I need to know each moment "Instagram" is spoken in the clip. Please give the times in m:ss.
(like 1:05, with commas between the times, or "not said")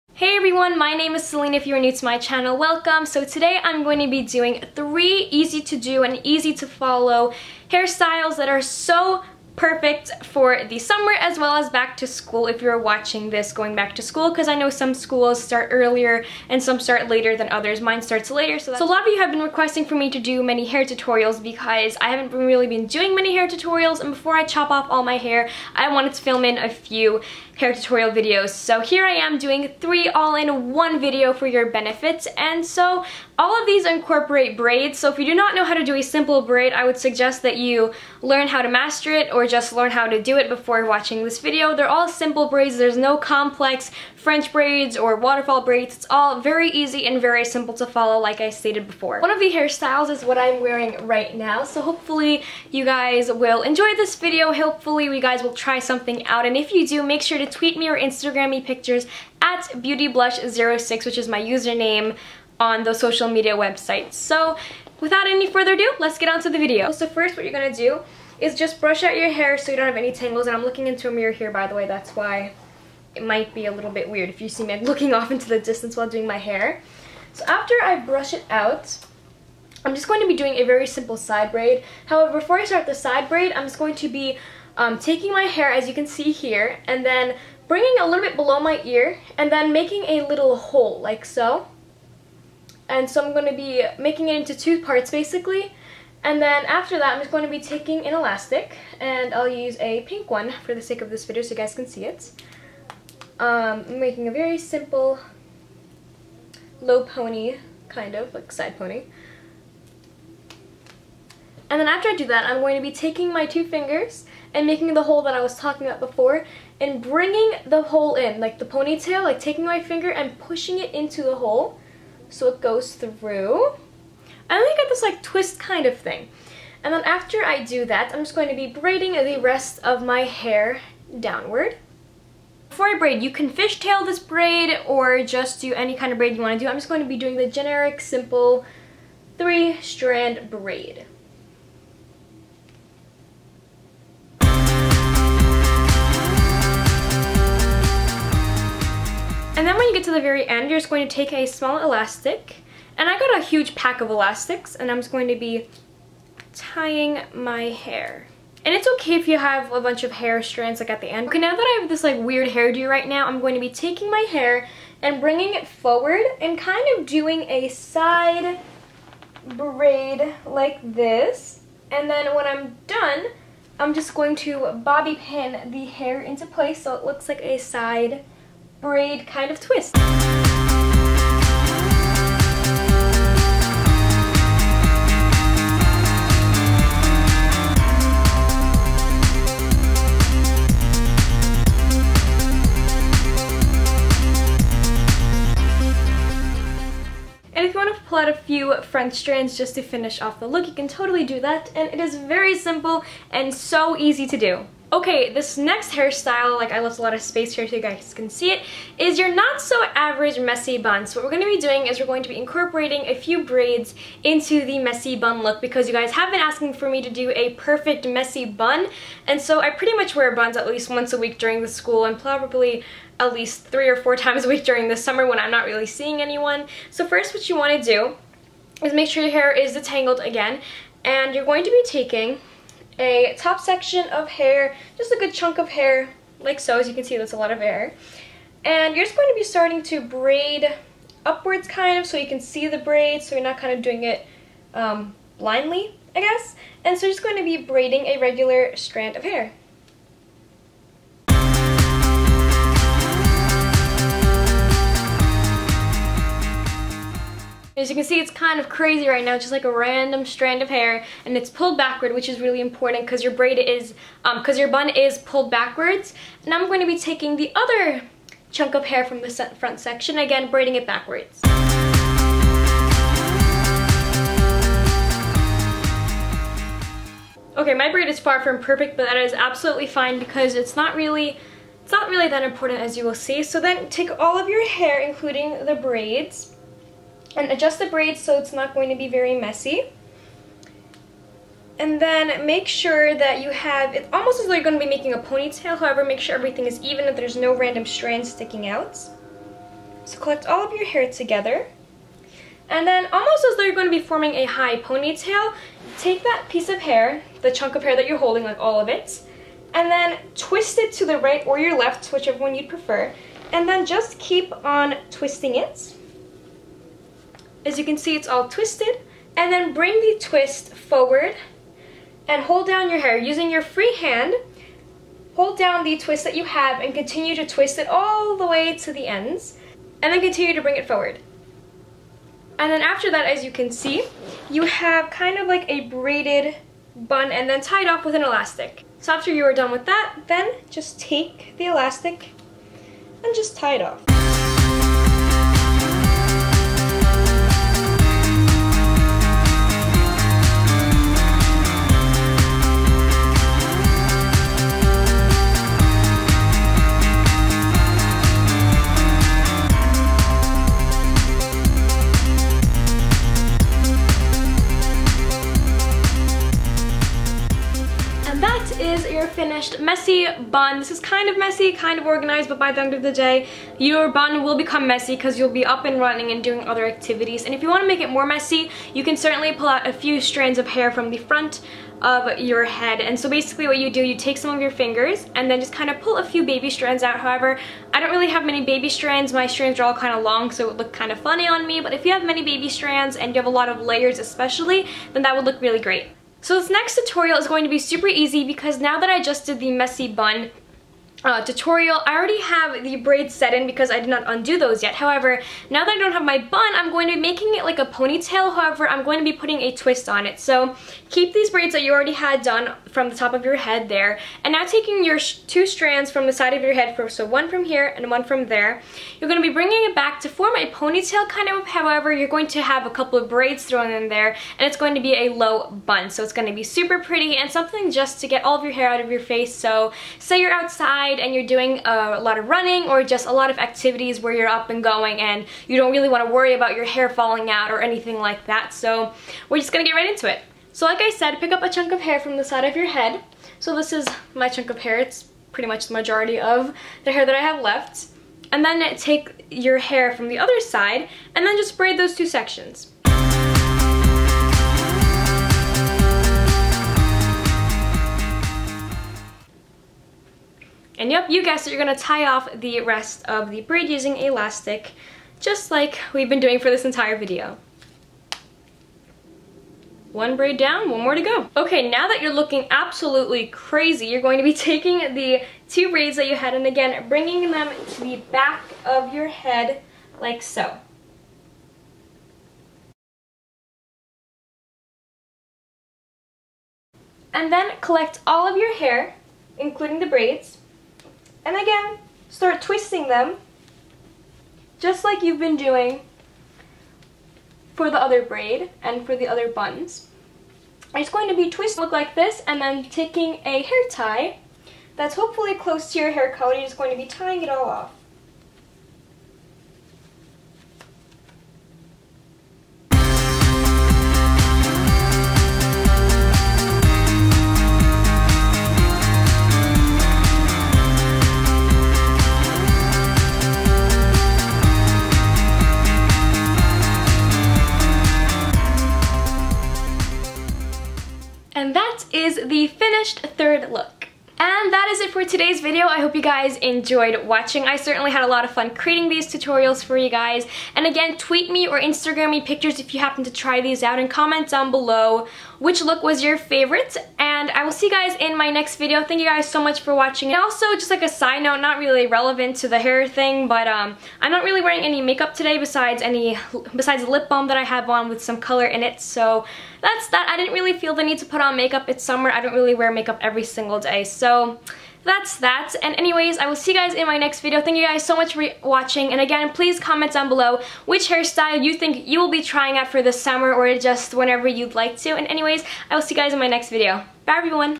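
0:57, 9:01.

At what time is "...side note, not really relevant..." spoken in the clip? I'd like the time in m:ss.
9:11.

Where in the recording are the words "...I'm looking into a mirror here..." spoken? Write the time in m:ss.
1:10.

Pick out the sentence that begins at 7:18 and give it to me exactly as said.
So we're just going to get right into it.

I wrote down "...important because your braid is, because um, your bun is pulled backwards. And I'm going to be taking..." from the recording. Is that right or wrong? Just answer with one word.
right.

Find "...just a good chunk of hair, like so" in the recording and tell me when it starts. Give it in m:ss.
3:54.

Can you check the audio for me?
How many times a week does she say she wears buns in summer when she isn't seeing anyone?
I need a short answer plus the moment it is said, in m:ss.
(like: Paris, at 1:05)
3 or 4, at 3:43.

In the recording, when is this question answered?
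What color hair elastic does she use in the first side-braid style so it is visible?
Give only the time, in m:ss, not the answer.
1:40.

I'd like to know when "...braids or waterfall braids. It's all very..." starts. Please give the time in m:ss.
0:44.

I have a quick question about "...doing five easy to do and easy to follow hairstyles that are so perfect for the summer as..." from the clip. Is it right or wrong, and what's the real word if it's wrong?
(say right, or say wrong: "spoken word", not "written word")
wrong: "three", not "five".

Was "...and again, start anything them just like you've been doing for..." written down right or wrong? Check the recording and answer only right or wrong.
wrong.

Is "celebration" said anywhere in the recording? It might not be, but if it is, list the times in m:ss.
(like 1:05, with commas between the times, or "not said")
not said.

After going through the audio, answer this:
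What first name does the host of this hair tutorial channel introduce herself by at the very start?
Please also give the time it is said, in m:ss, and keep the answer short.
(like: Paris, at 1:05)
Selin, at 0:01.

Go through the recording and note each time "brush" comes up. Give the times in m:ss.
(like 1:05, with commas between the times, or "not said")
1:08, 1:17.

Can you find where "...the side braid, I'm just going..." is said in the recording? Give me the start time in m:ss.
1:22.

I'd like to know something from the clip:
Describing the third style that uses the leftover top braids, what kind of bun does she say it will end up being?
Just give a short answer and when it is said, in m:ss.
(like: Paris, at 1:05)
Low bun, at 7:05.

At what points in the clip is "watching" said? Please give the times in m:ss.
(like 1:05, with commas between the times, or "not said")
0:12, 0:40, 8:57, 9:09, 9:28.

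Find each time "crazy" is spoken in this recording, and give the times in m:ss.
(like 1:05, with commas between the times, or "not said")
4:18, 7:53.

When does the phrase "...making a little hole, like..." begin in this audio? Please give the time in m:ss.
1:29.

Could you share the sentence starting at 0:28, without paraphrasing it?
So here I am doing three all-in-one video for your benefits and so all of these incorporate braids.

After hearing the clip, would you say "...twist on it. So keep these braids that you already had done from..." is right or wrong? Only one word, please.
right.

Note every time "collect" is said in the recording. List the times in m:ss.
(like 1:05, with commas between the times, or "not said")
5:00, 8:07.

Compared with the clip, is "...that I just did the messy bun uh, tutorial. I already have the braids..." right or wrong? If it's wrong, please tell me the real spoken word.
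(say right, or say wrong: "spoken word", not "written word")
right.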